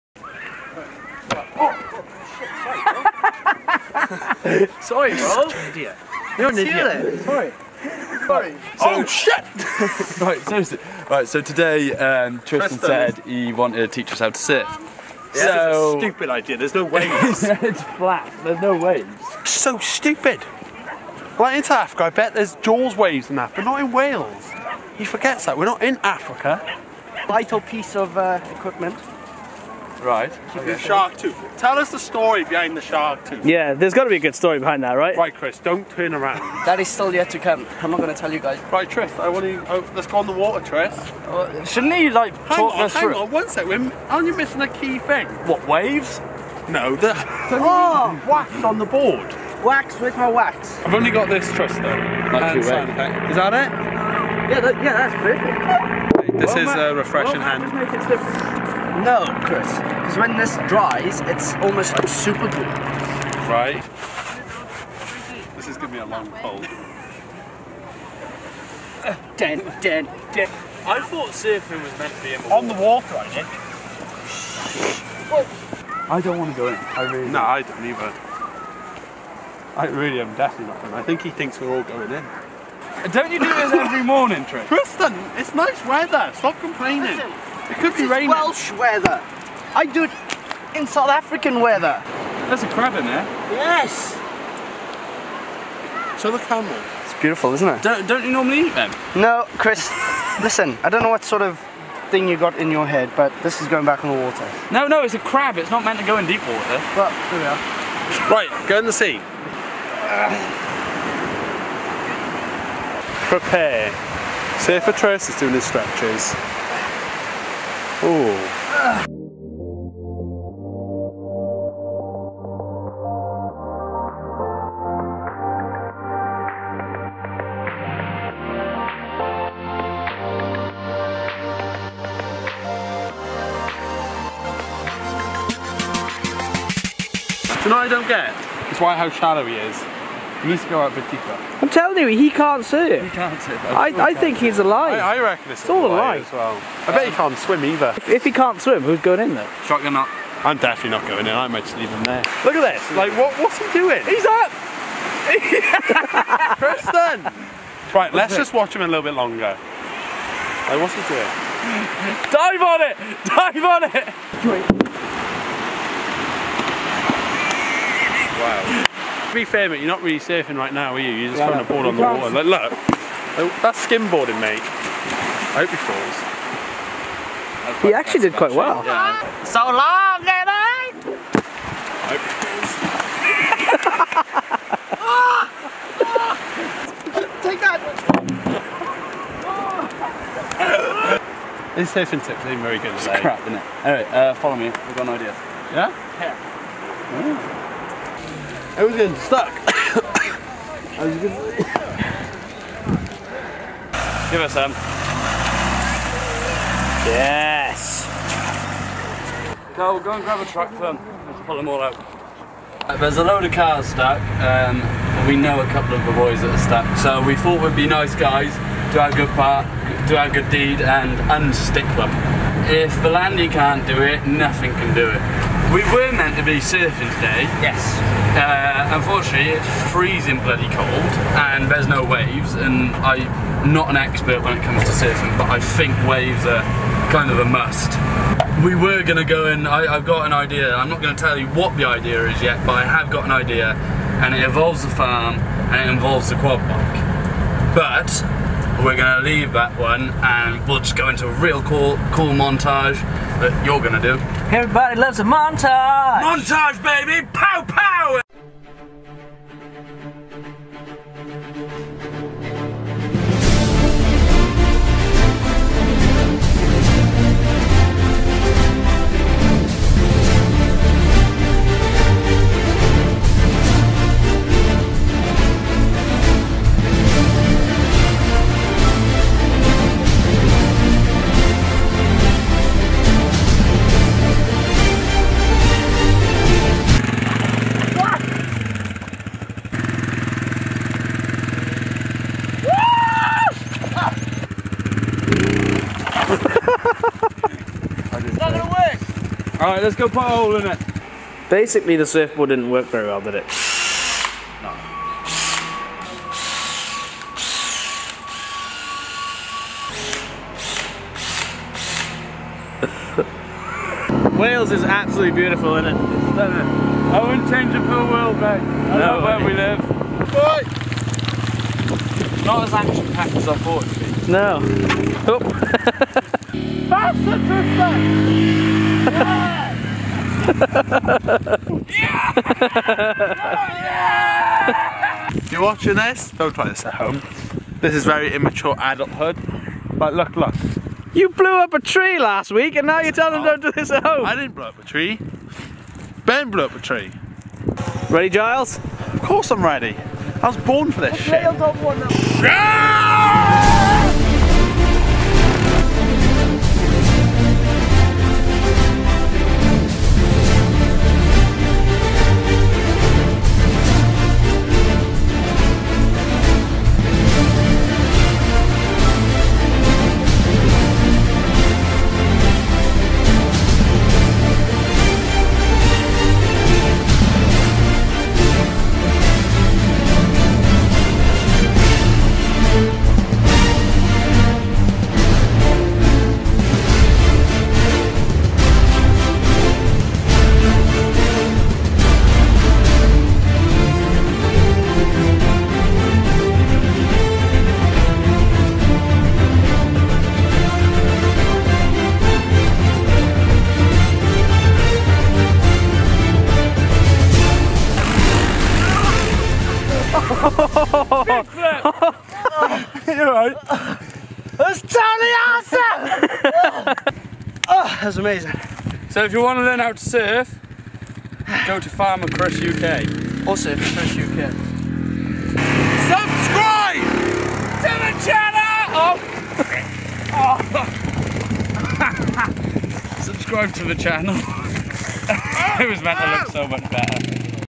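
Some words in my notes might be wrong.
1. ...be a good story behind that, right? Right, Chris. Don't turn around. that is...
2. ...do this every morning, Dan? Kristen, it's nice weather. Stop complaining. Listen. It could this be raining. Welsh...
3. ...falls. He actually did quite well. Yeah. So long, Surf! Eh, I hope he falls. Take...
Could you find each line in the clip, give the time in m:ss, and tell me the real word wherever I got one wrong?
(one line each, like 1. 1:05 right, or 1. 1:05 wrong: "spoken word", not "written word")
1. 0:34 right
2. 1:23 wrong: "Tristan", not "Dan"
3. 2:55 wrong: "Lenny", not "Surf".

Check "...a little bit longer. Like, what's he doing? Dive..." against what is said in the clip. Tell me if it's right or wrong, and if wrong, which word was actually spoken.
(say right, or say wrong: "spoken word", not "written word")
right.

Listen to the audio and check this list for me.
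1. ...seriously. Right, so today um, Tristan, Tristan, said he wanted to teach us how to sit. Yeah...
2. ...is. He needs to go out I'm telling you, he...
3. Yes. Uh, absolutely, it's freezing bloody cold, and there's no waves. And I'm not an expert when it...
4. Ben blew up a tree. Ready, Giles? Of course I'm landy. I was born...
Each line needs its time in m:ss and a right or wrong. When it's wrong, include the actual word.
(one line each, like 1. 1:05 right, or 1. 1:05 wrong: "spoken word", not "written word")
1. 0:10 right
2. 2:19 right
3. 3:47 wrong: "unfortunately", not "absolutely"
4. 5:46 wrong: "ready", not "landy".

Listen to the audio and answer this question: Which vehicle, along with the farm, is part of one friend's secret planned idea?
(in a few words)
Quad bike.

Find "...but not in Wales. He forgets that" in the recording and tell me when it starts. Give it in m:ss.
0:23.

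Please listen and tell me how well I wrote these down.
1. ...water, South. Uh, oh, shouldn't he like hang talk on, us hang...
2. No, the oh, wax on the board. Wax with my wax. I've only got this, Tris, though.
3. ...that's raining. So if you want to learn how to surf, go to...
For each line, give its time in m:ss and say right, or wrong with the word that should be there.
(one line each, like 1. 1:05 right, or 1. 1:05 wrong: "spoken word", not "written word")
1. 0:40 wrong: "Tris", not "South"
2. 0:46 right
3. 6:58 wrong: "amazing", not "raining".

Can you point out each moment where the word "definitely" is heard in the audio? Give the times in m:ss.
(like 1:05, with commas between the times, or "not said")
1:20, 2:30.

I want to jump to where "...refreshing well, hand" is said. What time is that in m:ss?
0:56.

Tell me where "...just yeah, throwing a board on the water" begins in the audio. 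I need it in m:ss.
2:51.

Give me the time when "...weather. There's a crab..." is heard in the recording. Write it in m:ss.
1:31.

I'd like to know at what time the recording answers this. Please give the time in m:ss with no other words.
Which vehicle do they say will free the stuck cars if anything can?
3:43.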